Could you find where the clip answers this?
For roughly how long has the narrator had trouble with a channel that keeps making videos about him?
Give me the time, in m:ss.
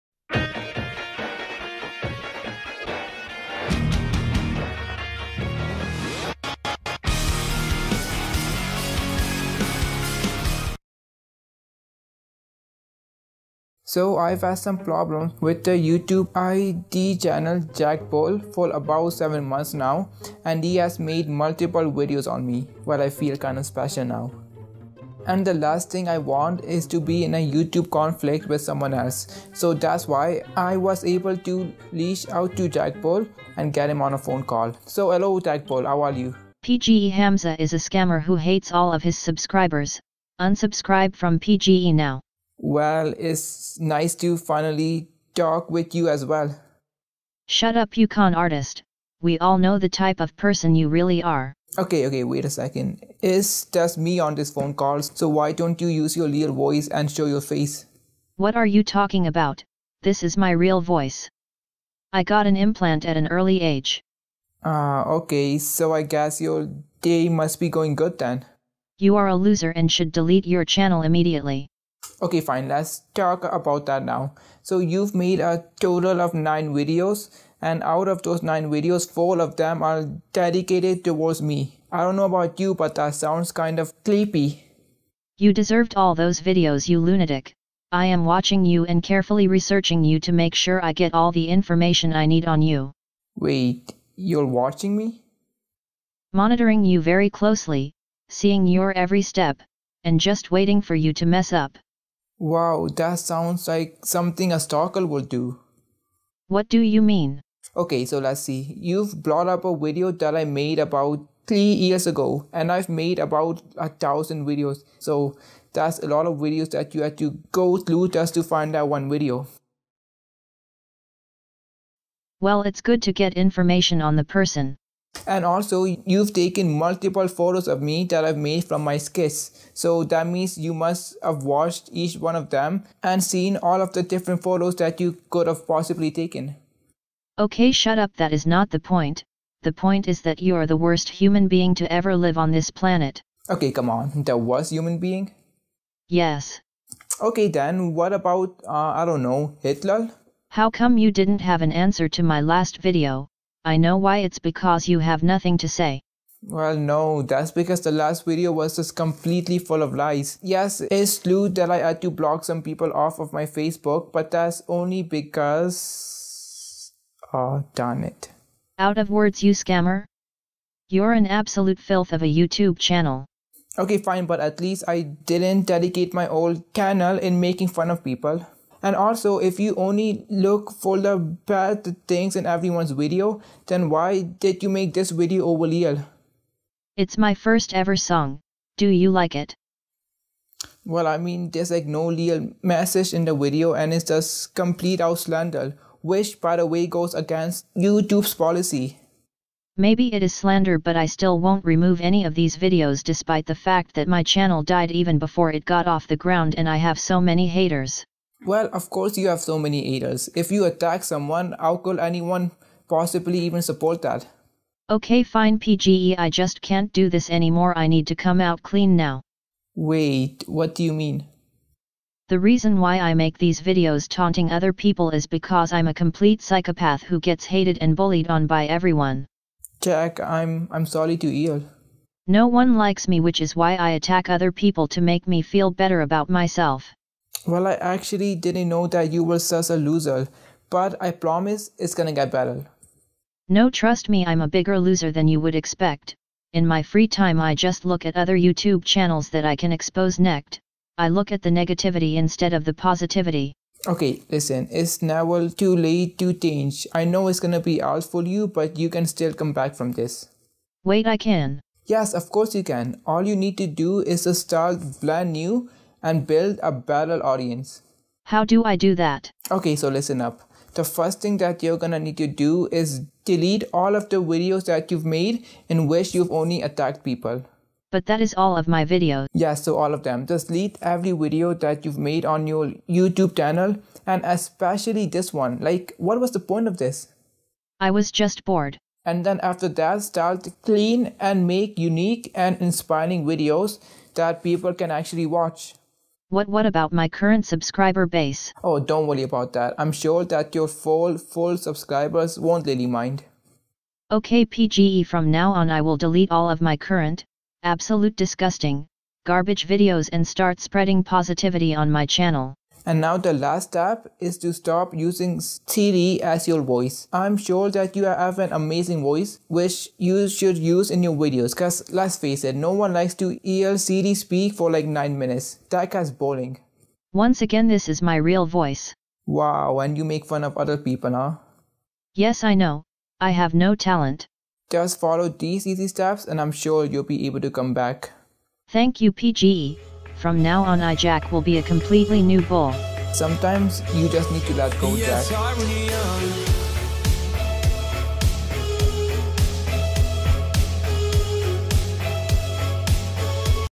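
0:19.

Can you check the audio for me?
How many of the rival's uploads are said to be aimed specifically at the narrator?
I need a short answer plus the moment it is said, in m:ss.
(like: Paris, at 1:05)
4, at 1:19.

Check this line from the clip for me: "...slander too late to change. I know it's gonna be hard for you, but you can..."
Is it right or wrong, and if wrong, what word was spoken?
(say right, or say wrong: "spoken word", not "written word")
wrong: "never", not "slander".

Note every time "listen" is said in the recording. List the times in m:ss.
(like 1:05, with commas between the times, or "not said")
4:14, 4:29.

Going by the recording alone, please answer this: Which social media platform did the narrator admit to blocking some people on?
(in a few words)
Facebook.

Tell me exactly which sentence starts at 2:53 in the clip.
Okay, fine, but at least I didn't dedicate my old channel in making fun of people.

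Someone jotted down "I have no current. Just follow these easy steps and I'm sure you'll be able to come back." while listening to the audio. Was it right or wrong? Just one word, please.
wrong.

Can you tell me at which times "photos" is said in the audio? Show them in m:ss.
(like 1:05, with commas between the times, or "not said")
2:07, 2:14.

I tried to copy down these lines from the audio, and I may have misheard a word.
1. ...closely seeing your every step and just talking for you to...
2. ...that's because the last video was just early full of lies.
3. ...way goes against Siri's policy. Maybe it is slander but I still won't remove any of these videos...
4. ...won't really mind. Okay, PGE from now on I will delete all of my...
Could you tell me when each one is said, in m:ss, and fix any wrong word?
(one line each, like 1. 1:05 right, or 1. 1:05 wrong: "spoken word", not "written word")
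1. 1:37 wrong: "waiting", not "talking"
2. 2:37 wrong: "completely", not "early"
3. 3:16 wrong: "YouTube", not "Siri"
4. 5:02 right.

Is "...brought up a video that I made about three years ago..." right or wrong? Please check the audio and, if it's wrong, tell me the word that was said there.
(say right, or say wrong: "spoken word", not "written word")
right.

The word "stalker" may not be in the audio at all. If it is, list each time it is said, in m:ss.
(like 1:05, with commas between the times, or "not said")
1:44.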